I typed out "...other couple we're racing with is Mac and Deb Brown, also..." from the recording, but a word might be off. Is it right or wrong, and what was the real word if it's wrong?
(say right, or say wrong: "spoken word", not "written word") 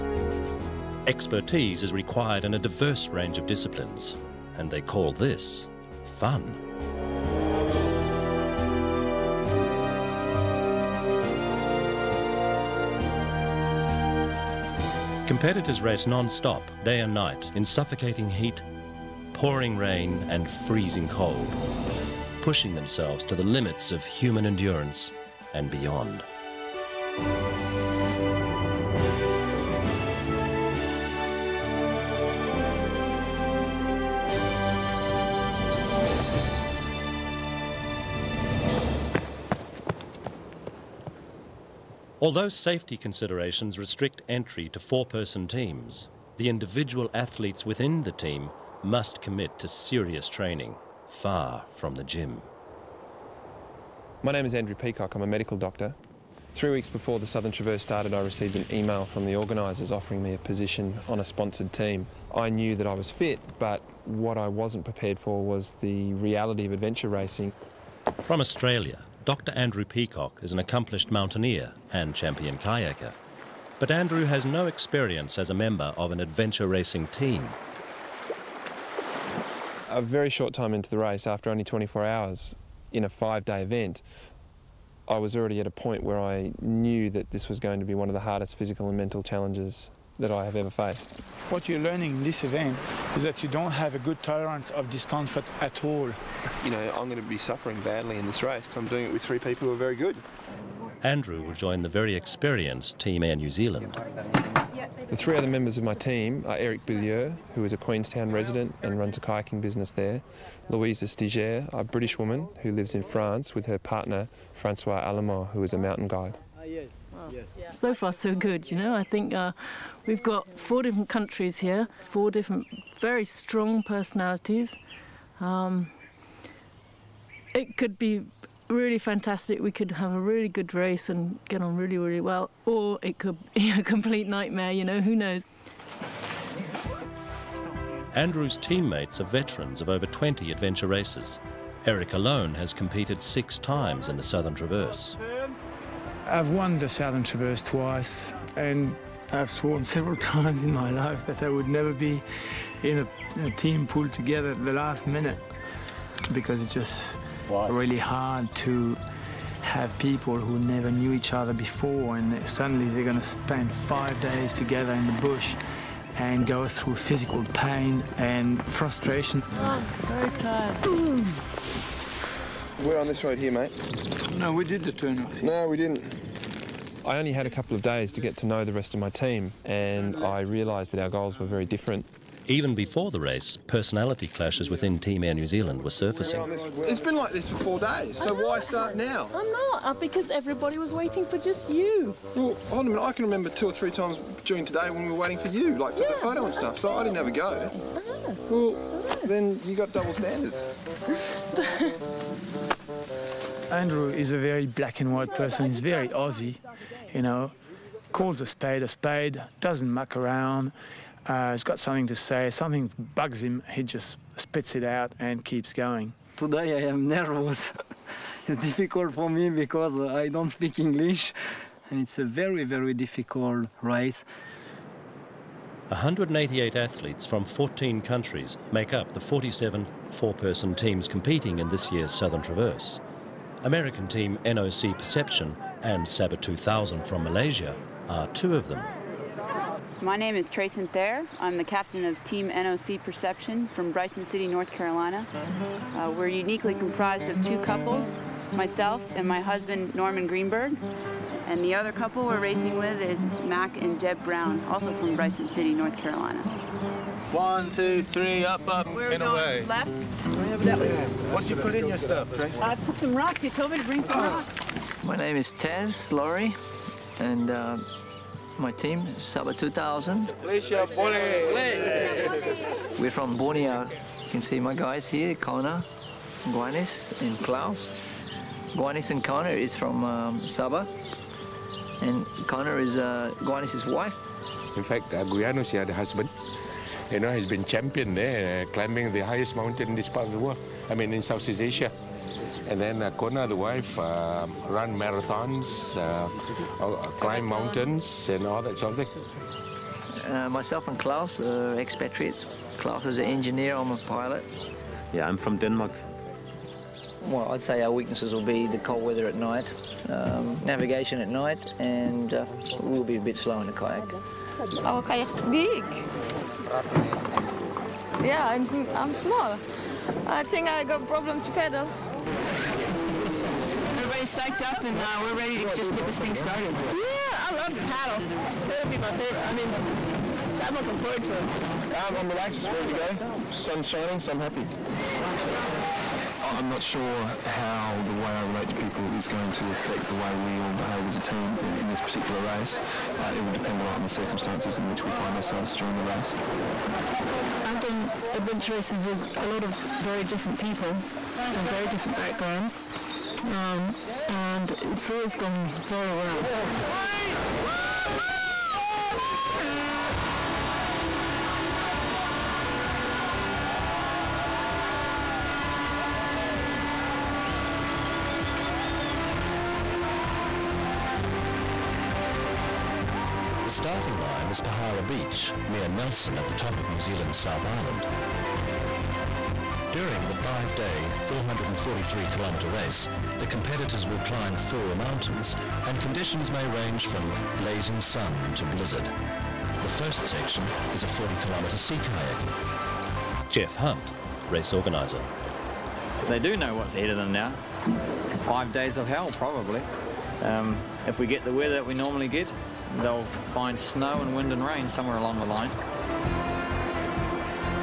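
right.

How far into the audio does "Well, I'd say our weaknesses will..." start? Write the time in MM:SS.
05:07.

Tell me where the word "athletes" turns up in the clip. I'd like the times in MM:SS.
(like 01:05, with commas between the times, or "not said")
00:47, 03:46.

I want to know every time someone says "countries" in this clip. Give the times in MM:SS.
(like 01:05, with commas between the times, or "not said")
02:01, 03:48.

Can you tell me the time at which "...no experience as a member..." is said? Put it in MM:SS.
01:14.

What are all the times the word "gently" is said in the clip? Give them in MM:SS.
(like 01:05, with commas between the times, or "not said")
not said.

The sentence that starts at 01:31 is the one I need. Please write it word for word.
What you're learning in this event is that you don't have a good tolerance of discomfort at all.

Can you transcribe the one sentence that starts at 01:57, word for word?
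So far, so good, you know.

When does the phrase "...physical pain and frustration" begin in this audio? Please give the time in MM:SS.
02:46.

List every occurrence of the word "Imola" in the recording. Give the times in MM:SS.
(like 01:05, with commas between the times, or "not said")
not said.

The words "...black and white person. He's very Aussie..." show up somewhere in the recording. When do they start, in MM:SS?
03:24.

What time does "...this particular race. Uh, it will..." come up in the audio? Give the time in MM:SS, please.
05:41.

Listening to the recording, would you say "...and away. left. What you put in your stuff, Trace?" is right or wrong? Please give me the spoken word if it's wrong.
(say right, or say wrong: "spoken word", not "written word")
right.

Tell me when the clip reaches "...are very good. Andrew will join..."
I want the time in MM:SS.
01:39.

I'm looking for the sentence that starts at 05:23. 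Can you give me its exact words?
Everybody's psyched up and uh, we're ready to just get this thing started.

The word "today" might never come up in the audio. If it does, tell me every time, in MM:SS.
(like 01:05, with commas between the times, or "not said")
03:14, 03:36.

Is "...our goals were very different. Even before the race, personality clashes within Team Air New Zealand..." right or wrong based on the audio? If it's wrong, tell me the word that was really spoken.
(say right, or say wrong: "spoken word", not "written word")
right.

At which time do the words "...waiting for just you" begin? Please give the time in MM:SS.
03:10.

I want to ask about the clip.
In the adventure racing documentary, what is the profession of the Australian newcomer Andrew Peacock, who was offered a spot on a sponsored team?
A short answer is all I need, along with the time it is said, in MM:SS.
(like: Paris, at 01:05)
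medical doctor, at 00:55.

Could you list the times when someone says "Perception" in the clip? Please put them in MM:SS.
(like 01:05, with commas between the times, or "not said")
03:54, 04:03.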